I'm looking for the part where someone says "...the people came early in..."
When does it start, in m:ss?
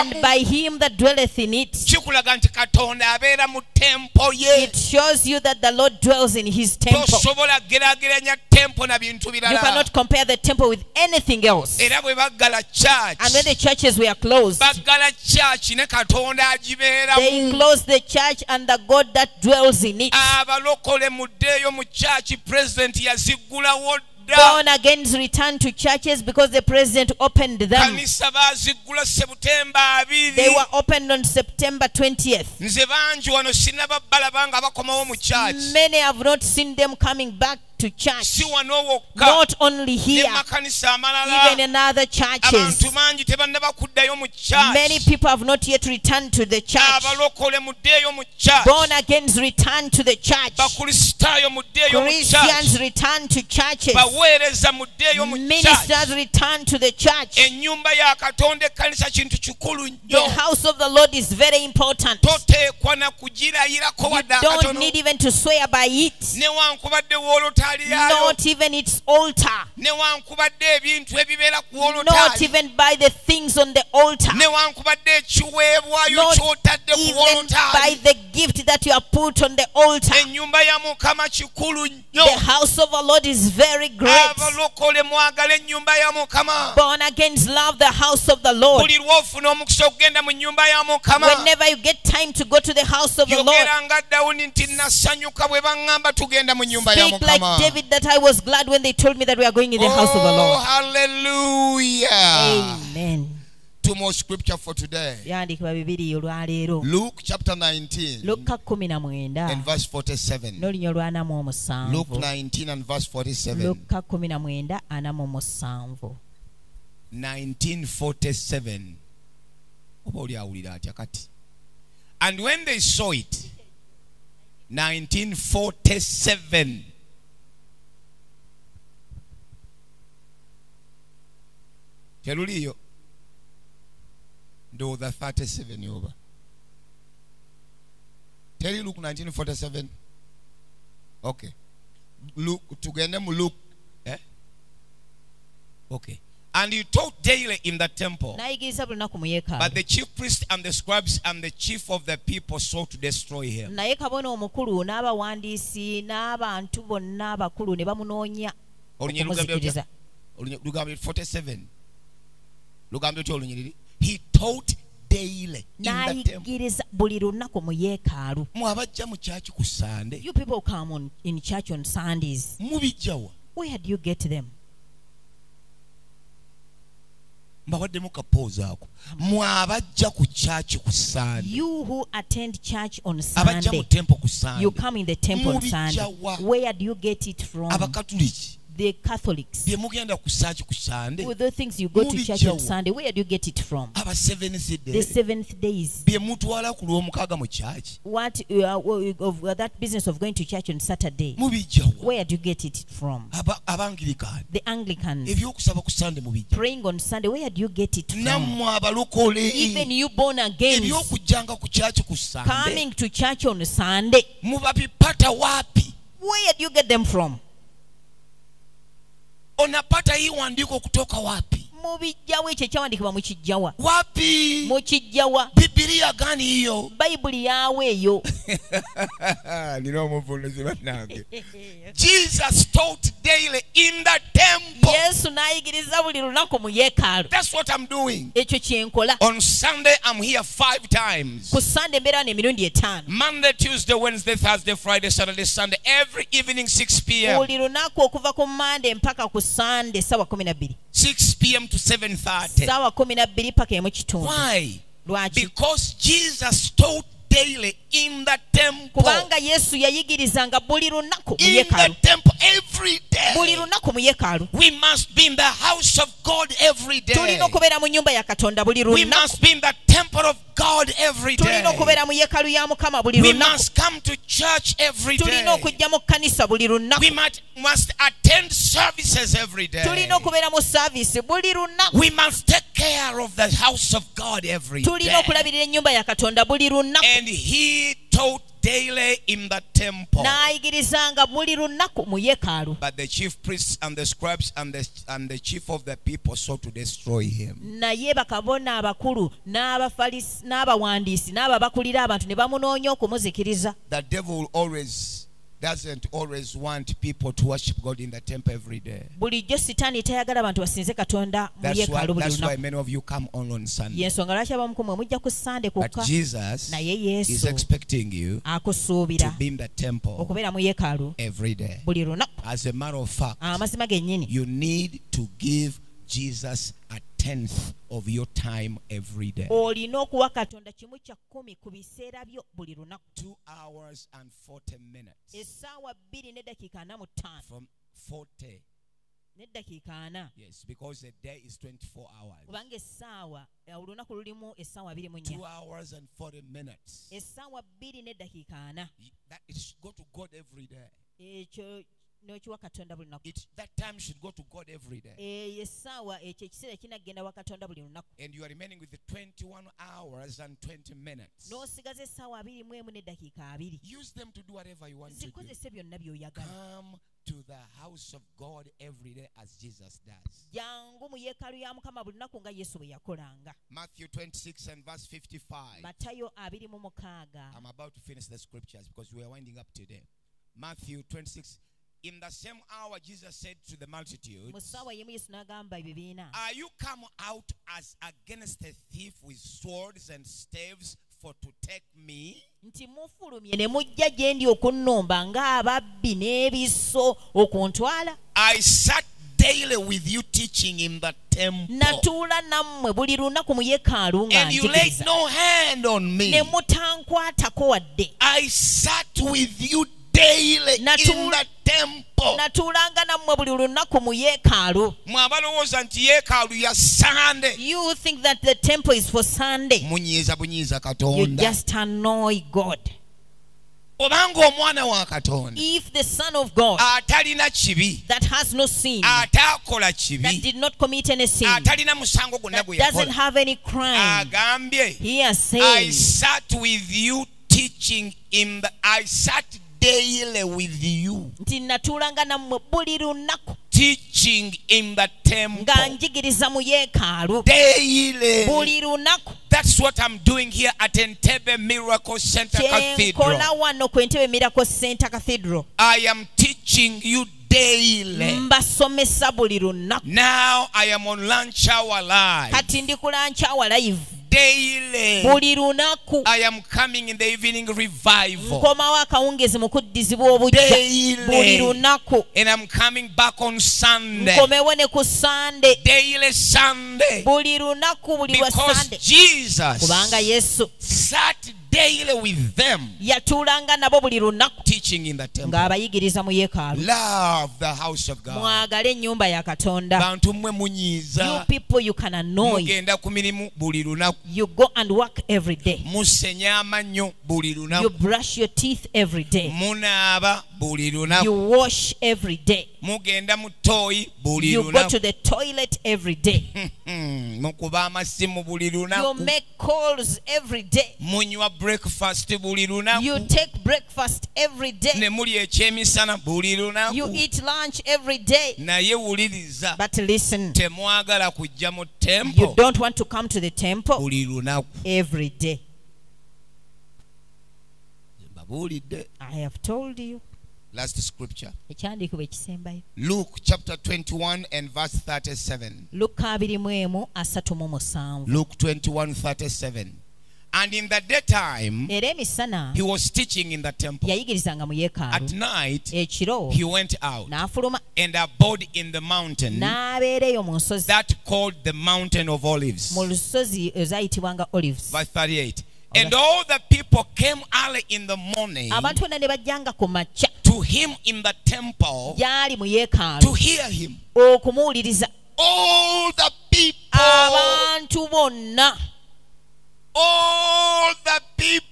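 9:16.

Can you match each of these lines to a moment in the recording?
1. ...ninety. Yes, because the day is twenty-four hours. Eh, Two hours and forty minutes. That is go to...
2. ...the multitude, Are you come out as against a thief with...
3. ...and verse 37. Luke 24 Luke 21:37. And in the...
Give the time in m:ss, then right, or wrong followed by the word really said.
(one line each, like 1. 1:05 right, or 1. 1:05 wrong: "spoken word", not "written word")
1. 5:37 wrong: "forty", not "ninety"
2. 6:23 right
3. 8:54 wrong: "21", not "24".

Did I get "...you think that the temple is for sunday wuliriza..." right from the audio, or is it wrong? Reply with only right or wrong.
wrong.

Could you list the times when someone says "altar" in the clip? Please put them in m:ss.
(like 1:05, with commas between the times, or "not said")
1:09, 1:13, 1:19.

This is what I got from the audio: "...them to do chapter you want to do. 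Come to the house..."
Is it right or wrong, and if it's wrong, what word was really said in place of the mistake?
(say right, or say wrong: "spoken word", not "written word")
wrong: "whatever", not "chapter".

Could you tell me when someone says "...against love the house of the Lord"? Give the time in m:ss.
1:27.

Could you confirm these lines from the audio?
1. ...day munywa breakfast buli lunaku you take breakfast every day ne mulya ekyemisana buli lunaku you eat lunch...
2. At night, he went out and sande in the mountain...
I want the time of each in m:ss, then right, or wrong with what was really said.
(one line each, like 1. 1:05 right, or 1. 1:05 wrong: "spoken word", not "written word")
1. 8:30 right
2. 9:04 wrong: "abode", not "sande".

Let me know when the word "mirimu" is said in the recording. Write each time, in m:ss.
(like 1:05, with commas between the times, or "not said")
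8:13.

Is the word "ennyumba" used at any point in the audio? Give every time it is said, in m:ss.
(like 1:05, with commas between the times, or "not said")
4:45, 8:08.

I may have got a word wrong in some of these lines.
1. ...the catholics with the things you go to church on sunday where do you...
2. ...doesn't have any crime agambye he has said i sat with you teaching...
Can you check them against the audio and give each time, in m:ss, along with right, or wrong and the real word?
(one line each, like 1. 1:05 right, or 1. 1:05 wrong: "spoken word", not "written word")
1. 3:08 right
2. 7:12 right.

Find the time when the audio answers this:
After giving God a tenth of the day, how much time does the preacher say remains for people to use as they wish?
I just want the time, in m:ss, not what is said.
5:59.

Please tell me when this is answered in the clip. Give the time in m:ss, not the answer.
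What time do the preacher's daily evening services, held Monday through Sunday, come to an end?
4:11.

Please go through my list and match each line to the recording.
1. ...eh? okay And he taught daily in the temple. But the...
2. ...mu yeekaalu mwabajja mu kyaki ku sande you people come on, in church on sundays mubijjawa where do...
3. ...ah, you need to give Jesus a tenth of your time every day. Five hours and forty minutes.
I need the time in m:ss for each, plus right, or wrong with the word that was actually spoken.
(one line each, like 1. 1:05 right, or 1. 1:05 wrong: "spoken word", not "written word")
1. 2:24 right
2. 2:47 right
3. 5:23 wrong: "Two", not "Five".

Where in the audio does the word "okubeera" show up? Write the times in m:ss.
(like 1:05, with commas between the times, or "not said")
4:27, 4:31, 4:40.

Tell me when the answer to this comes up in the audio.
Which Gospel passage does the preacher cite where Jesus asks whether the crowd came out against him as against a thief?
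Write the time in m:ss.
6:13.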